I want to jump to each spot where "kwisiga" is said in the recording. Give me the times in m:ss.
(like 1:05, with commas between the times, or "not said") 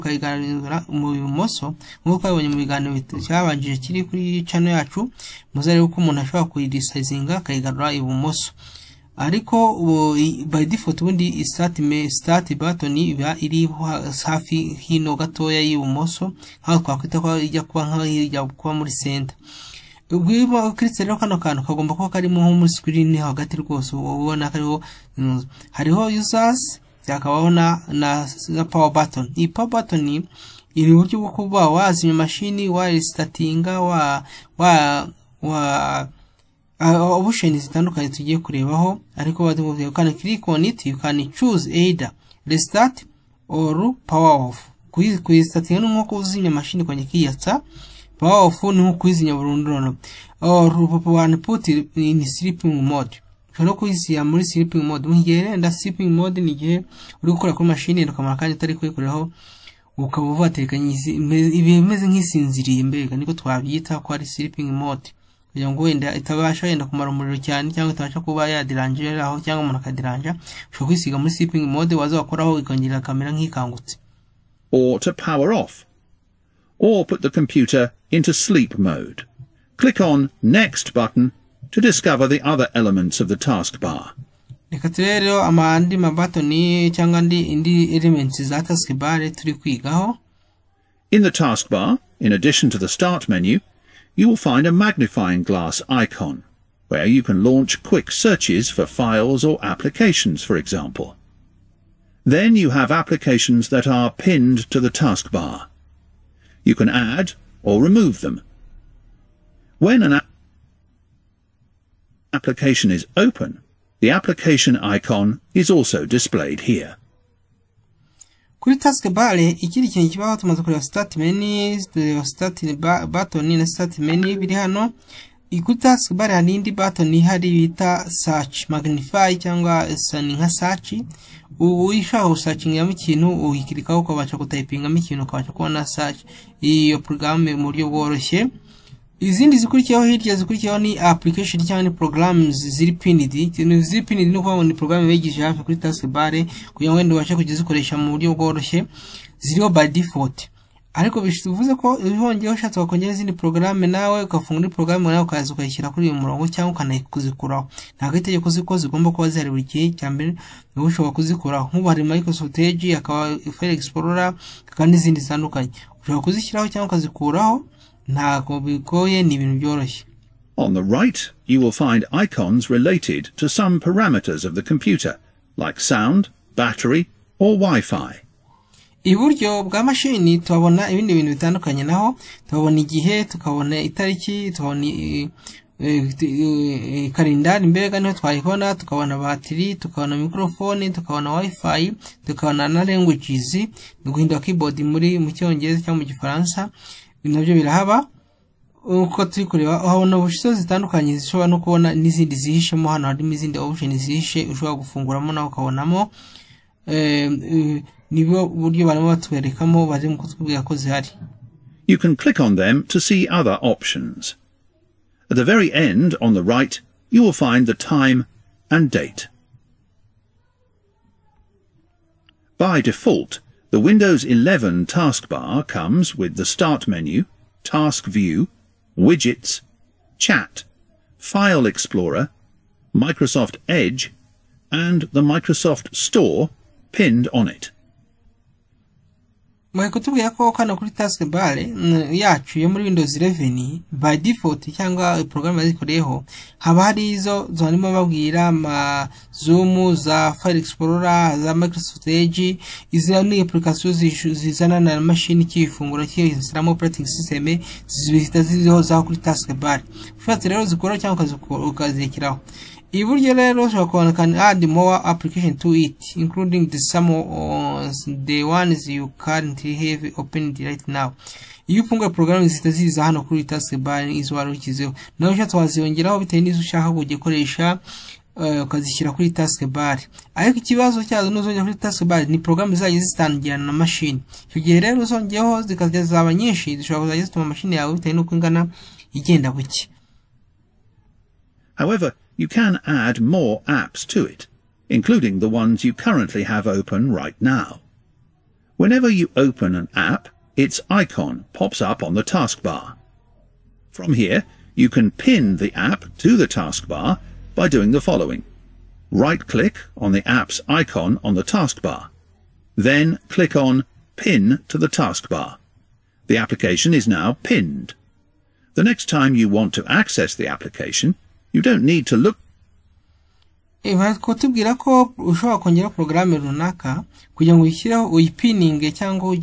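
1:10.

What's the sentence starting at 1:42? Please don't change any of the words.
Then you have applications that are pinned to the taskbar.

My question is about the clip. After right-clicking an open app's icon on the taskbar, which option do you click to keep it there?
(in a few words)
Pin to the taskbar.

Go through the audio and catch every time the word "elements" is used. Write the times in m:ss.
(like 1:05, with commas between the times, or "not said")
1:22, 1:27.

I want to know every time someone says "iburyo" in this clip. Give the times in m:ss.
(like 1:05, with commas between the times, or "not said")
2:59, 4:22.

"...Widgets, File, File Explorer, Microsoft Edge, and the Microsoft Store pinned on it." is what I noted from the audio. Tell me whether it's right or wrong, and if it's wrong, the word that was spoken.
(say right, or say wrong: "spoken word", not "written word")
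wrong: "Chat", not "File".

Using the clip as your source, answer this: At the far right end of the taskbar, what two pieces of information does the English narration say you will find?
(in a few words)
time and date.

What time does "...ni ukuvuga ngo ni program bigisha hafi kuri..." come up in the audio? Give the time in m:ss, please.
2:24.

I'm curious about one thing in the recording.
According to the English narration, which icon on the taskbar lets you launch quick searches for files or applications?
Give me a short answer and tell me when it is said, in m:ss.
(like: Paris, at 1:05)
magnifying glass icon, at 1:34.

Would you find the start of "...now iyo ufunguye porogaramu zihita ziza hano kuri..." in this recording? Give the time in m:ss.
4:30.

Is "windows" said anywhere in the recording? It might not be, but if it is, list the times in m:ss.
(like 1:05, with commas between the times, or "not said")
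3:43, 4:02.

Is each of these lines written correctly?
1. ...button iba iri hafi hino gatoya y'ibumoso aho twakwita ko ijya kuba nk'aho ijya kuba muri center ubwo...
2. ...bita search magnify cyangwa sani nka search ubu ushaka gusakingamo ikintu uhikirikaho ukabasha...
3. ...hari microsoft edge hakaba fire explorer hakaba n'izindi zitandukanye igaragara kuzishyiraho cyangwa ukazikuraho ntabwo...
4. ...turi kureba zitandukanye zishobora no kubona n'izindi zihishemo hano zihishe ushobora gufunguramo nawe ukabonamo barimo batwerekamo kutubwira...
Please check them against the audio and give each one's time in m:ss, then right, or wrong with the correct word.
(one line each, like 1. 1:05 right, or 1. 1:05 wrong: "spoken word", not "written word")
1. 0:12 right
2. 2:07 right
3. 2:41 wrong: "ushobora", not "igaragara"
4. 3:19 right.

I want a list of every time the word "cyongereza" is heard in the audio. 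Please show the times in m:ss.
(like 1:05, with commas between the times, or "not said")
3:15.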